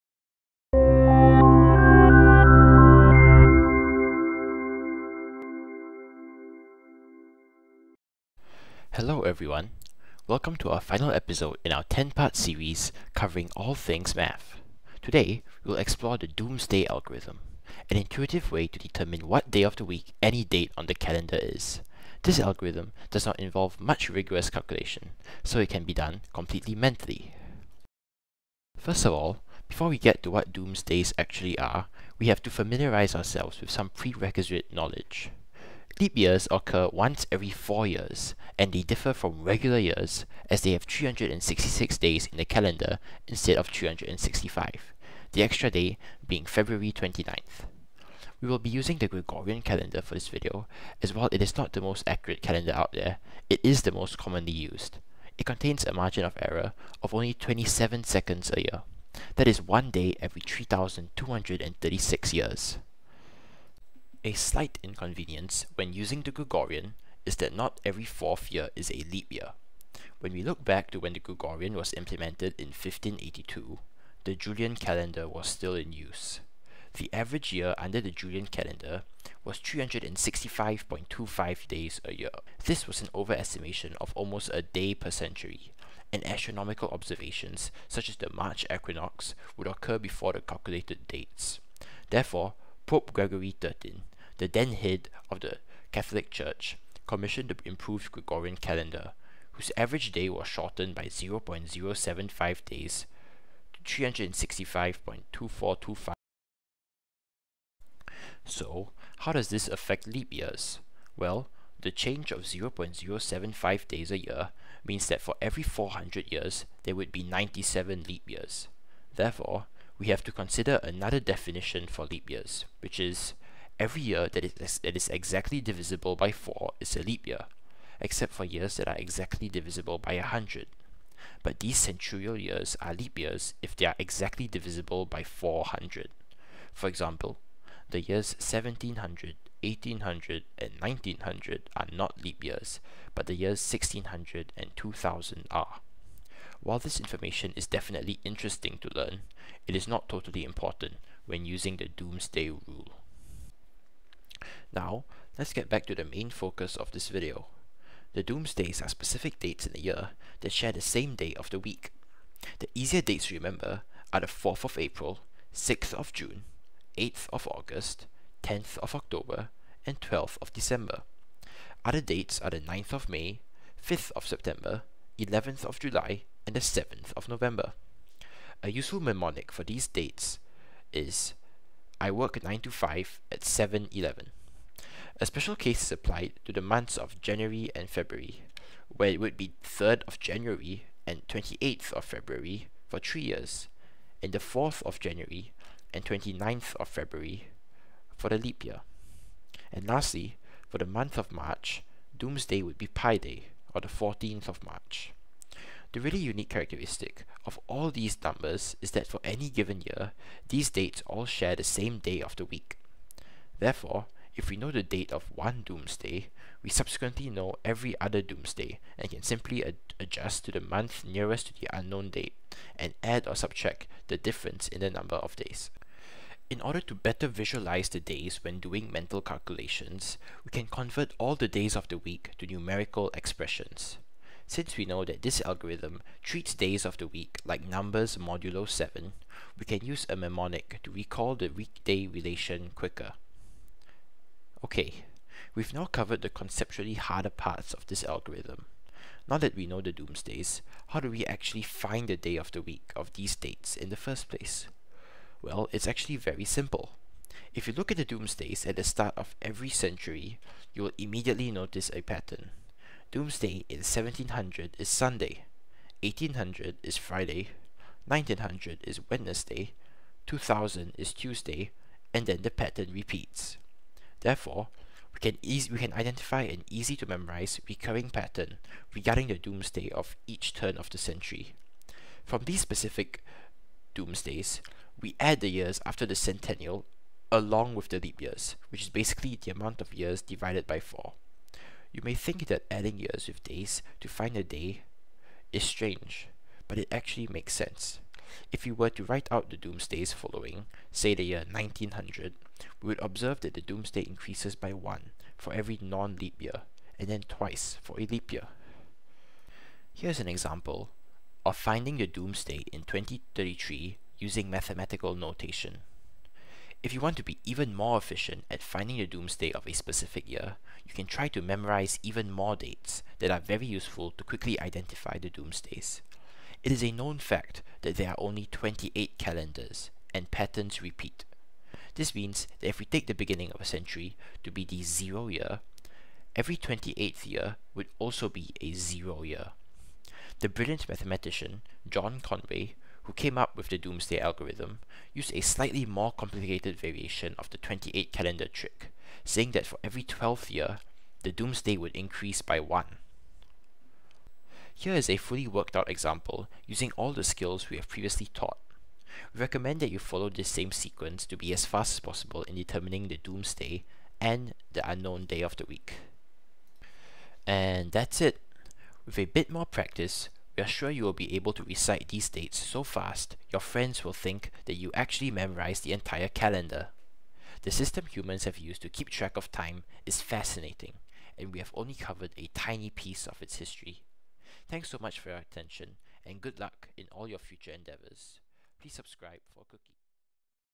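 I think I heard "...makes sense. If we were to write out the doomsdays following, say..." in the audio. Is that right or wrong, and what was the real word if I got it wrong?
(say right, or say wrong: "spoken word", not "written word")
right.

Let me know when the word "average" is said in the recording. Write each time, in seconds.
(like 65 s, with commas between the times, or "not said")
77 s, 99 s.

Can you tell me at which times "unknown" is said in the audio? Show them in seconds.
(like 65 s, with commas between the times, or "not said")
221 s, 364 s.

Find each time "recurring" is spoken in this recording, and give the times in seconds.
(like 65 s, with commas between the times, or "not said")
277 s.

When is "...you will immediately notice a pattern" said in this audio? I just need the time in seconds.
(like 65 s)
260 s.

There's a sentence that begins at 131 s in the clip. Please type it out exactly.
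But these centurial years are leap years if they are exactly divisible by 400.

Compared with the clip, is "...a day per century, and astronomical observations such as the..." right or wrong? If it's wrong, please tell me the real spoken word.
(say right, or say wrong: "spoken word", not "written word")
right.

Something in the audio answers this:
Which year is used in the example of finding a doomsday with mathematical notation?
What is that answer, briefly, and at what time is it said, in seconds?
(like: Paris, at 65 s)
2033, at 312 s.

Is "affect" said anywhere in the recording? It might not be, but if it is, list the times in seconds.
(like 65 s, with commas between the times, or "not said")
109 s.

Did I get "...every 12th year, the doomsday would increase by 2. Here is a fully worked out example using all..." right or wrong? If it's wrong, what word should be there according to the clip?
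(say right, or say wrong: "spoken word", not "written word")
wrong: "1", not "2".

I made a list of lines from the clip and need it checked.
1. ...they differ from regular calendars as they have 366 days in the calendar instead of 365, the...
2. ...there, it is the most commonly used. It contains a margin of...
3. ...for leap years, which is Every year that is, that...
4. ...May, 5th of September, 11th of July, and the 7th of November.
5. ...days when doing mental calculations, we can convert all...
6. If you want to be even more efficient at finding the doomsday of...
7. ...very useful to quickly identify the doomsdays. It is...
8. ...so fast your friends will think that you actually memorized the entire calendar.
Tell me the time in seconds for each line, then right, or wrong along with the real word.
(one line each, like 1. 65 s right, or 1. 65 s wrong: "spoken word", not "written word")
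1. 38 s wrong: "years", not "calendars"
2. 52 s right
3. 121 s right
4. 173 s right
5. 227 s right
6. 316 s right
7. 323 s right
8. 372 s right.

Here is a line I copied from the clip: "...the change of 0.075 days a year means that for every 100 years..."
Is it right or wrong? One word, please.
wrong.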